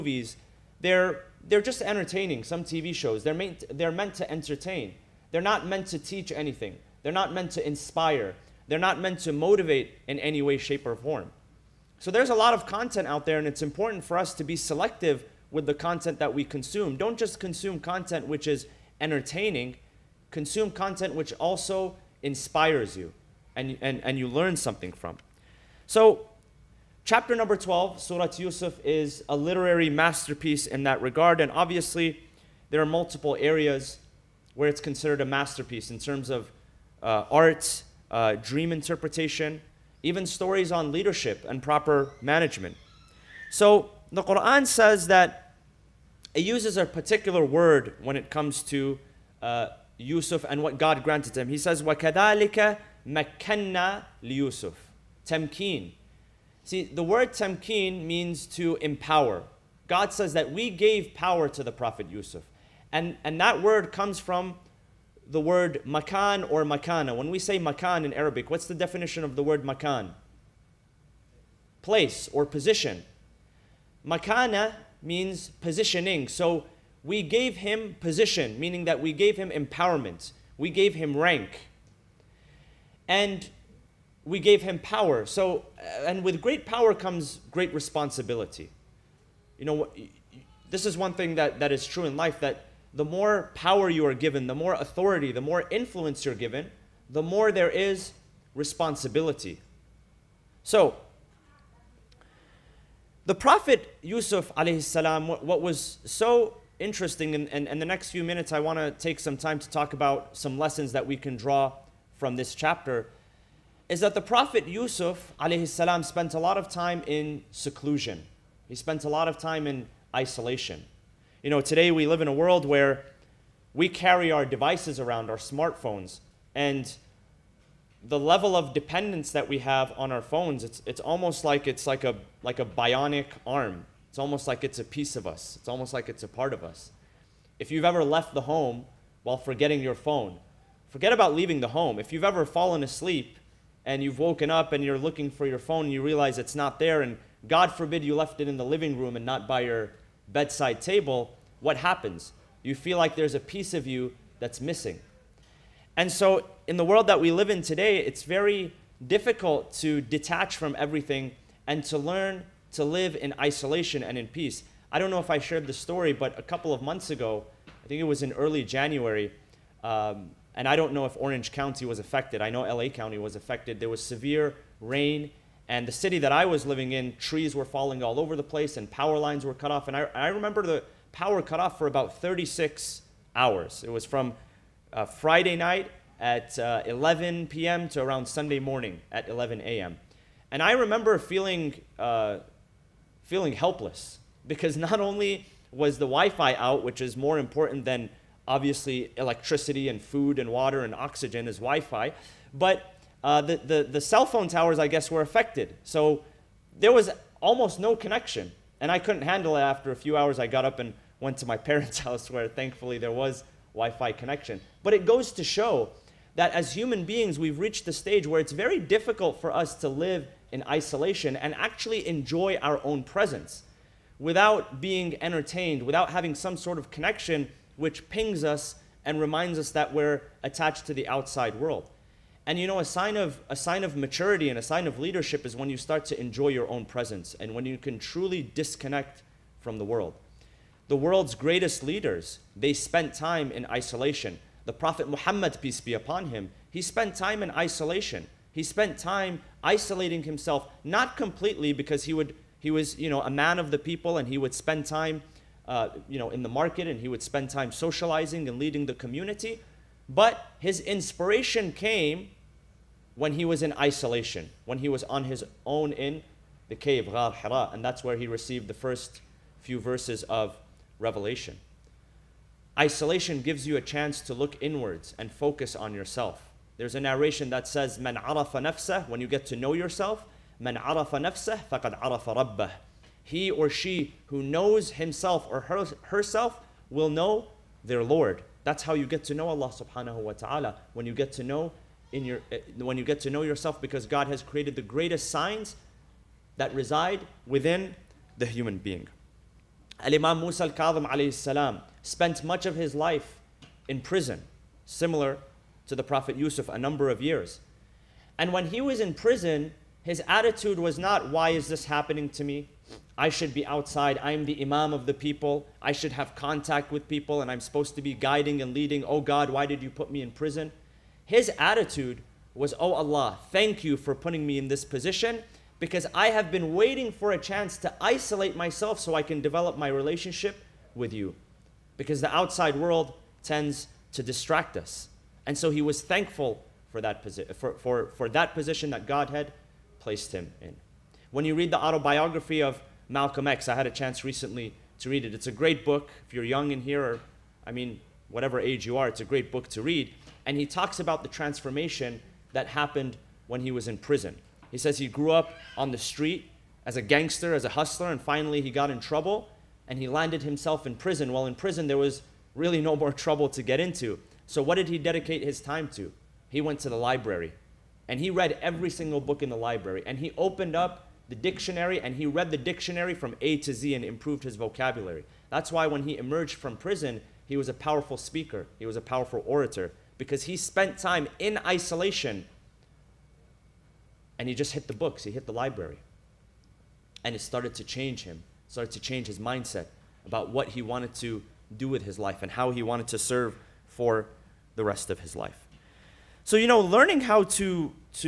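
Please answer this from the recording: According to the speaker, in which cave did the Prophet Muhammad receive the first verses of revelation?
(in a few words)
Ghar Hira.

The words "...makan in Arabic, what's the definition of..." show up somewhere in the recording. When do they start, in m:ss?
1:07.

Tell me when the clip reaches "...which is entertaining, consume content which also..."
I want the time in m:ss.
0:18.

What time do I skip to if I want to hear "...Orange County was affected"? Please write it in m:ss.
2:51.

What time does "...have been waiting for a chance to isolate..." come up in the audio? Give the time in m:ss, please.
5:26.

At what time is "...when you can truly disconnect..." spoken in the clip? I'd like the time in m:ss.
3:57.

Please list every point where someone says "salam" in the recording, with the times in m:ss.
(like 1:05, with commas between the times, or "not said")
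5:01.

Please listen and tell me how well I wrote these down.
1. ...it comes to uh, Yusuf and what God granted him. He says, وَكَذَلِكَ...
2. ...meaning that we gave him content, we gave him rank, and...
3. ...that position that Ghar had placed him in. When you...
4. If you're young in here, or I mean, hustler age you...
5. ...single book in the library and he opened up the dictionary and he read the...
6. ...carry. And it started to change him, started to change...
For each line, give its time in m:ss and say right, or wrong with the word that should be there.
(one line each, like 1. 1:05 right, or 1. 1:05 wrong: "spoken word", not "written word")
1. 0:48 right
2. 1:18 wrong: "empowerment", not "content"
3. 5:38 wrong: "God", not "Ghar"
4. 5:46 wrong: "whatever", not "hustler"
5. 6:08 right
6. 6:25 wrong: "library", not "carry".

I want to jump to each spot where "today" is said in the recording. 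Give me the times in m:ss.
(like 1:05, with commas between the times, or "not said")
2:01, 2:37.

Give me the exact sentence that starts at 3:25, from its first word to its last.
So there was almost no connection.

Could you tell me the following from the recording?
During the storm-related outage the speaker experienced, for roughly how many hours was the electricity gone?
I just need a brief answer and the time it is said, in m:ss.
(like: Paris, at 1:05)
36, at 3:02.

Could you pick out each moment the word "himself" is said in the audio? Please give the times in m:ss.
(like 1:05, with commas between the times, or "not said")
4:10, 4:44, 6:00.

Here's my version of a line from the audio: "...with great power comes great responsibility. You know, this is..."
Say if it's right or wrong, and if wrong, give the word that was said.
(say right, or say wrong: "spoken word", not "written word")
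right.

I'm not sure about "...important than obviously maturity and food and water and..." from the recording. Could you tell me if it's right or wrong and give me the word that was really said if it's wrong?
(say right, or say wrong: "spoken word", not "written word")
wrong: "electricity", not "maturity".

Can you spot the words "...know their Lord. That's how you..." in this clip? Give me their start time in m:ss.
4:47.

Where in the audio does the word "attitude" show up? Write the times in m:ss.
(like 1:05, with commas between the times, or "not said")
5:10, 5:21.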